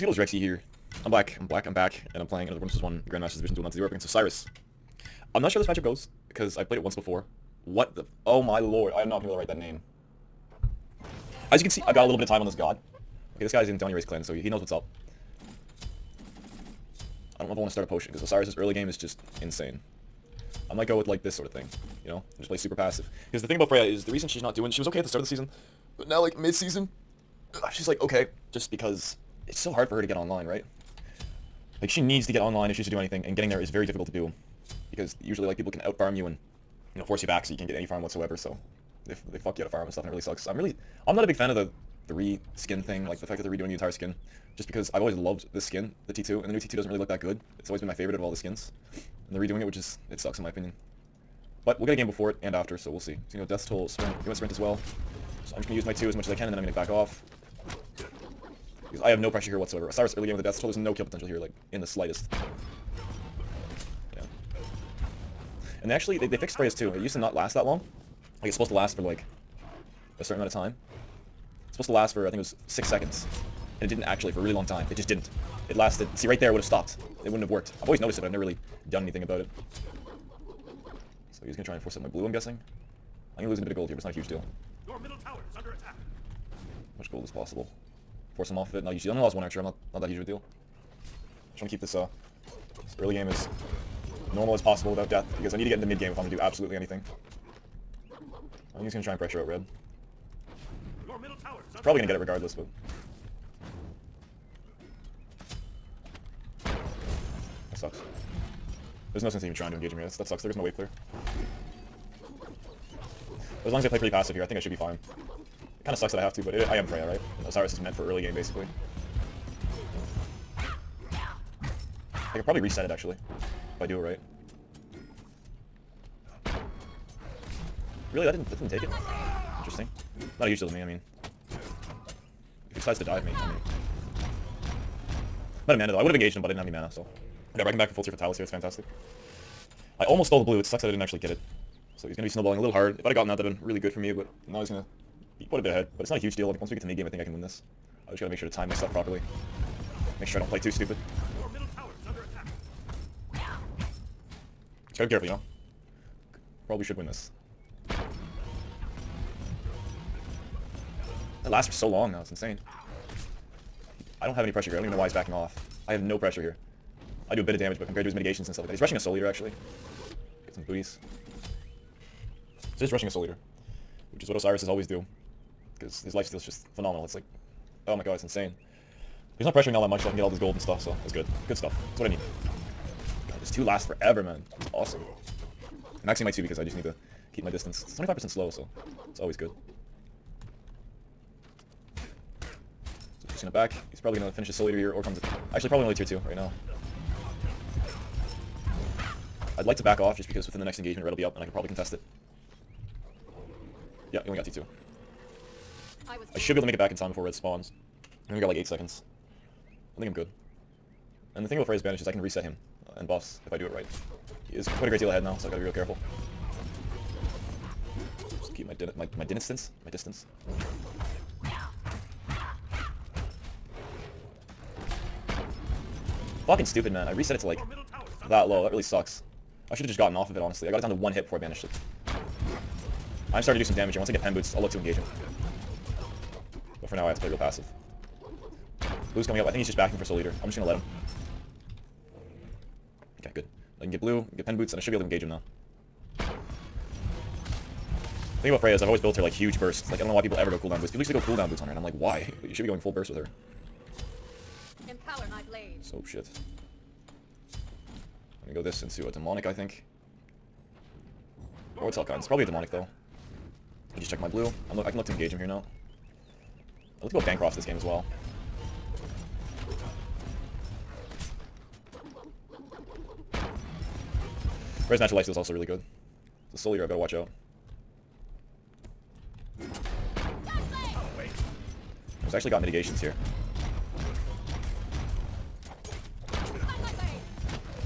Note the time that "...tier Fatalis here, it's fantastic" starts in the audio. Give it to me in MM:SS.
02:18.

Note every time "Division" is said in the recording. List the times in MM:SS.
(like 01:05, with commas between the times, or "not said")
00:03.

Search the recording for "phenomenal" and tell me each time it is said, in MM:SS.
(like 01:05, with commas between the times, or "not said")
02:56.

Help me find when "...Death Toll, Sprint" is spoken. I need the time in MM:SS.
00:53.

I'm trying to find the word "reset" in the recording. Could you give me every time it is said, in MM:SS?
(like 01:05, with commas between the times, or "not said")
02:02, 03:32, 03:47.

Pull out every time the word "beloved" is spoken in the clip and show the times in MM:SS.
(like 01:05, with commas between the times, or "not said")
not said.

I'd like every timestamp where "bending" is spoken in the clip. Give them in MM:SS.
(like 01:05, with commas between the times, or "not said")
not said.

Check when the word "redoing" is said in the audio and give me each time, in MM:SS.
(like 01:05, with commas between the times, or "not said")
00:43, 00:49.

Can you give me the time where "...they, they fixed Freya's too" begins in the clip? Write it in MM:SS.
01:06.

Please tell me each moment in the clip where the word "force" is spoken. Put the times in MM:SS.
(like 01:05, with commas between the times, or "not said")
00:37, 01:21, 01:28.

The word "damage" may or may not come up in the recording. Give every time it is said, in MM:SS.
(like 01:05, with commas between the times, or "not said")
02:47, 03:53.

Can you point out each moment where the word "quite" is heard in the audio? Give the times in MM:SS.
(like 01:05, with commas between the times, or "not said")
02:25, 03:34.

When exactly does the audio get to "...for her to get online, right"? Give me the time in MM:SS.
00:29.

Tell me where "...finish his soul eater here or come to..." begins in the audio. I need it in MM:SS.
03:14.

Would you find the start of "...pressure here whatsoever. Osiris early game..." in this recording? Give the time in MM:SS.
00:59.